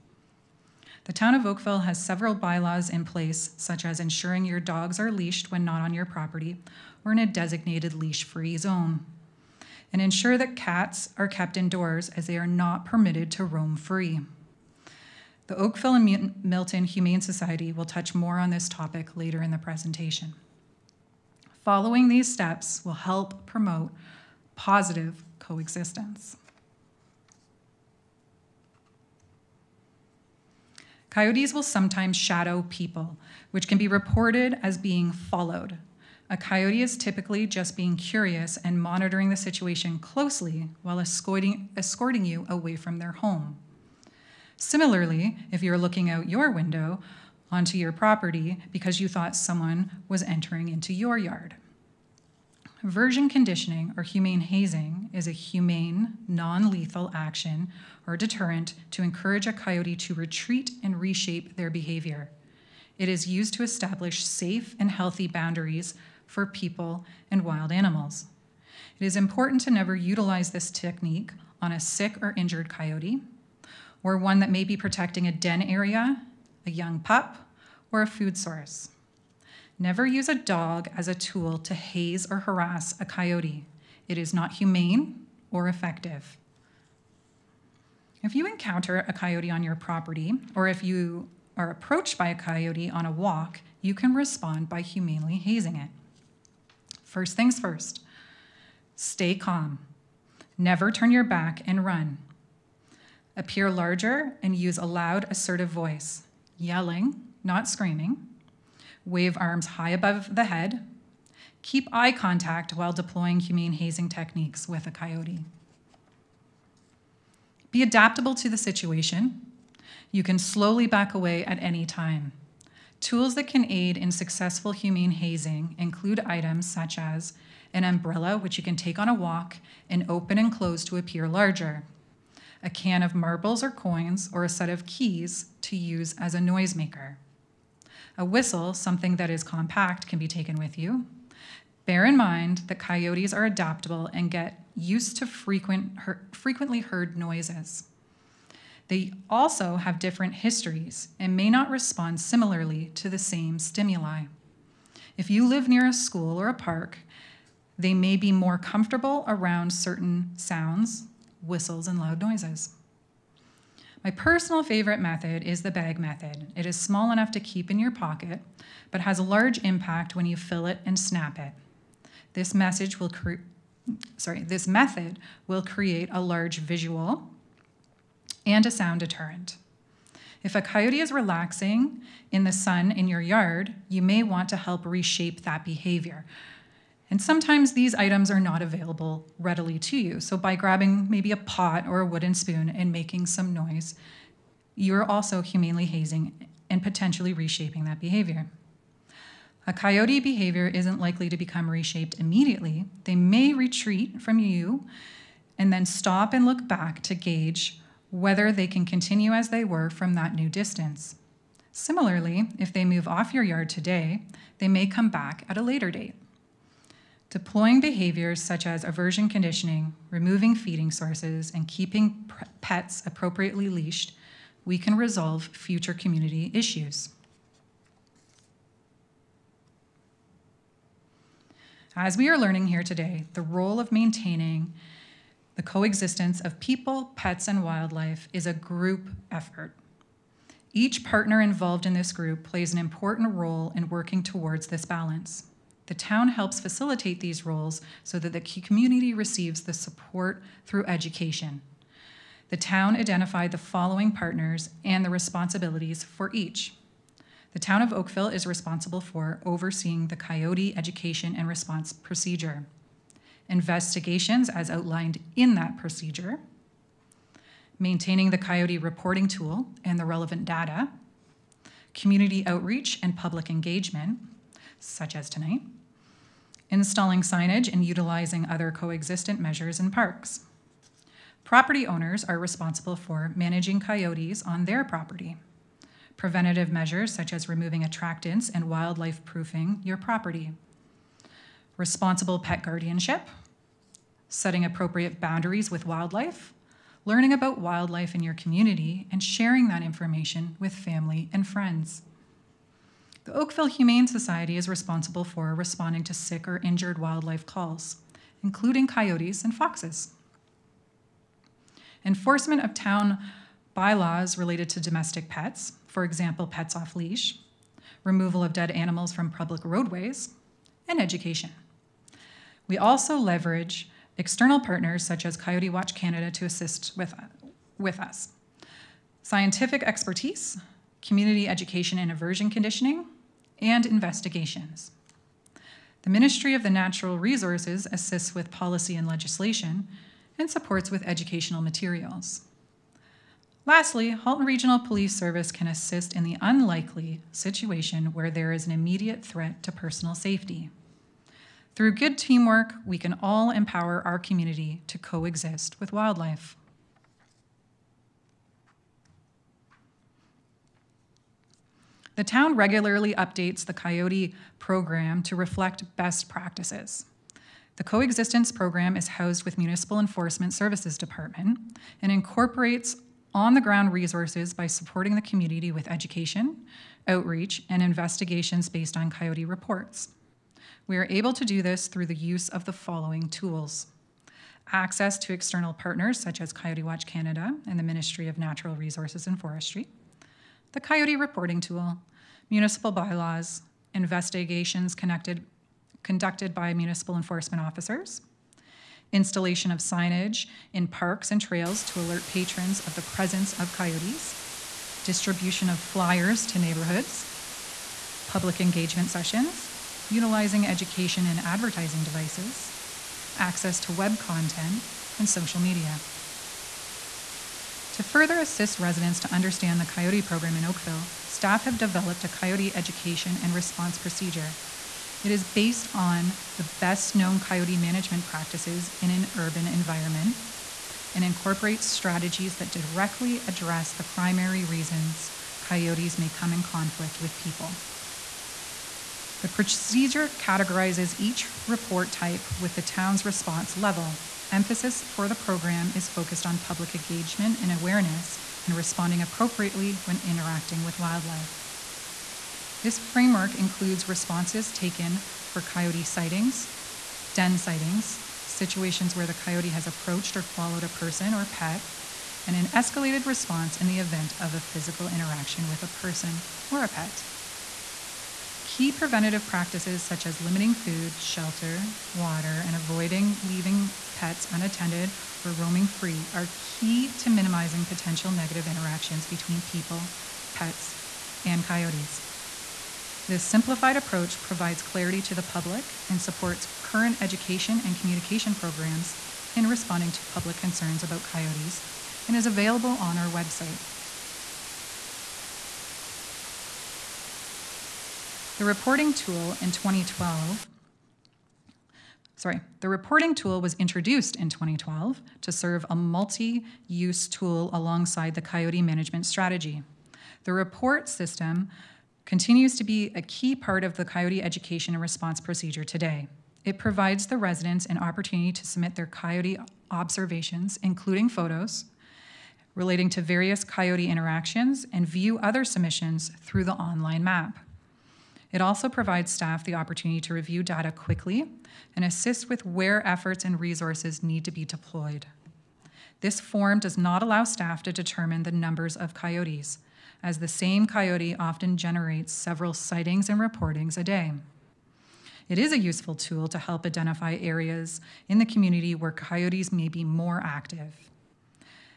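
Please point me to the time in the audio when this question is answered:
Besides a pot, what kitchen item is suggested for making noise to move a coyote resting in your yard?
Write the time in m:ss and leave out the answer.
3:12.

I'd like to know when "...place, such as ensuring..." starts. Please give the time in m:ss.
0:03.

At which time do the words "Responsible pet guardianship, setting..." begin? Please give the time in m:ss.
4:51.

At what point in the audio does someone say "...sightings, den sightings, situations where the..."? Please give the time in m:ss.
7:36.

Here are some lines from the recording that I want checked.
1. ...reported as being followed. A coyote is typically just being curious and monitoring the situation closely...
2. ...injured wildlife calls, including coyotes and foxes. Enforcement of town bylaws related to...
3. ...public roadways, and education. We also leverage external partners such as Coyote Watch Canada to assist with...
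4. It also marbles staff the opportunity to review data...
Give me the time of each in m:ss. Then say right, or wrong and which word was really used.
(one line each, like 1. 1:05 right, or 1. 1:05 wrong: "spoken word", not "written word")
1. 0:33 right
2. 5:06 right
3. 5:19 right
4. 8:48 wrong: "provides", not "marbles".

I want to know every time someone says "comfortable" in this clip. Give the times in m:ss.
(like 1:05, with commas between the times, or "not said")
2:38.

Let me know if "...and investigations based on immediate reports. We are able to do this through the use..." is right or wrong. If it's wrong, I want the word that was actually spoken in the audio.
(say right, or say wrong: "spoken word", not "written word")
wrong: "coyote", not "immediate".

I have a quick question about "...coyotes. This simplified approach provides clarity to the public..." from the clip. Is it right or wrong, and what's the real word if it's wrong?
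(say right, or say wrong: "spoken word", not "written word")
right.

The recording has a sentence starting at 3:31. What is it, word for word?
Similarly, if they move off your yard today, they may come back at a later date.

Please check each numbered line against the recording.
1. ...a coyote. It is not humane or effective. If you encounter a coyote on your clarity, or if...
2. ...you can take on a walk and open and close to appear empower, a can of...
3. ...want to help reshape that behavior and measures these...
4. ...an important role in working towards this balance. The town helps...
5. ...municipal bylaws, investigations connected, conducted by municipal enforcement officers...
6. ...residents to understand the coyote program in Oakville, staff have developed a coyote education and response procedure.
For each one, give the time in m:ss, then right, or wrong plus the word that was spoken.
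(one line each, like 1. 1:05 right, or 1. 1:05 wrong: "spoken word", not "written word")
1. 1:23 wrong: "property", not "clarity"
2. 2:08 wrong: "larger", not "empower"
3. 3:04 wrong: "sometimes", not "measures"
4. 4:02 right
5. 6:32 right
6. 6:58 right.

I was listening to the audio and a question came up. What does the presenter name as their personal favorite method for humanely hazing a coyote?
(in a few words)
The bag method.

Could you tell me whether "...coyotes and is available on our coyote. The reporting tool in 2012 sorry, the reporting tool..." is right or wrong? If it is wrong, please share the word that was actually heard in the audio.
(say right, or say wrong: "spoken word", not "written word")
wrong: "website", not "coyote".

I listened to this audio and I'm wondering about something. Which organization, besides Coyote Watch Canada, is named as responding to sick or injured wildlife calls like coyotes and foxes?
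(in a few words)
Oakville Humane Society.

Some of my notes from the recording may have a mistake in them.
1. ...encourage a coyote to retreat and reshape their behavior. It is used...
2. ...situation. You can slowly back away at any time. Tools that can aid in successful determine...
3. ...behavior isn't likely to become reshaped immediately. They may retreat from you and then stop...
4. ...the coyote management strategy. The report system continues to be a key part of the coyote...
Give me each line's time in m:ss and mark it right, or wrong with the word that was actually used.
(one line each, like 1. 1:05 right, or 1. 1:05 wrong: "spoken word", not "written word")
1. 0:59 right
2. 1:58 wrong: "humane", not "determine"
3. 3:20 right
4. 8:28 right.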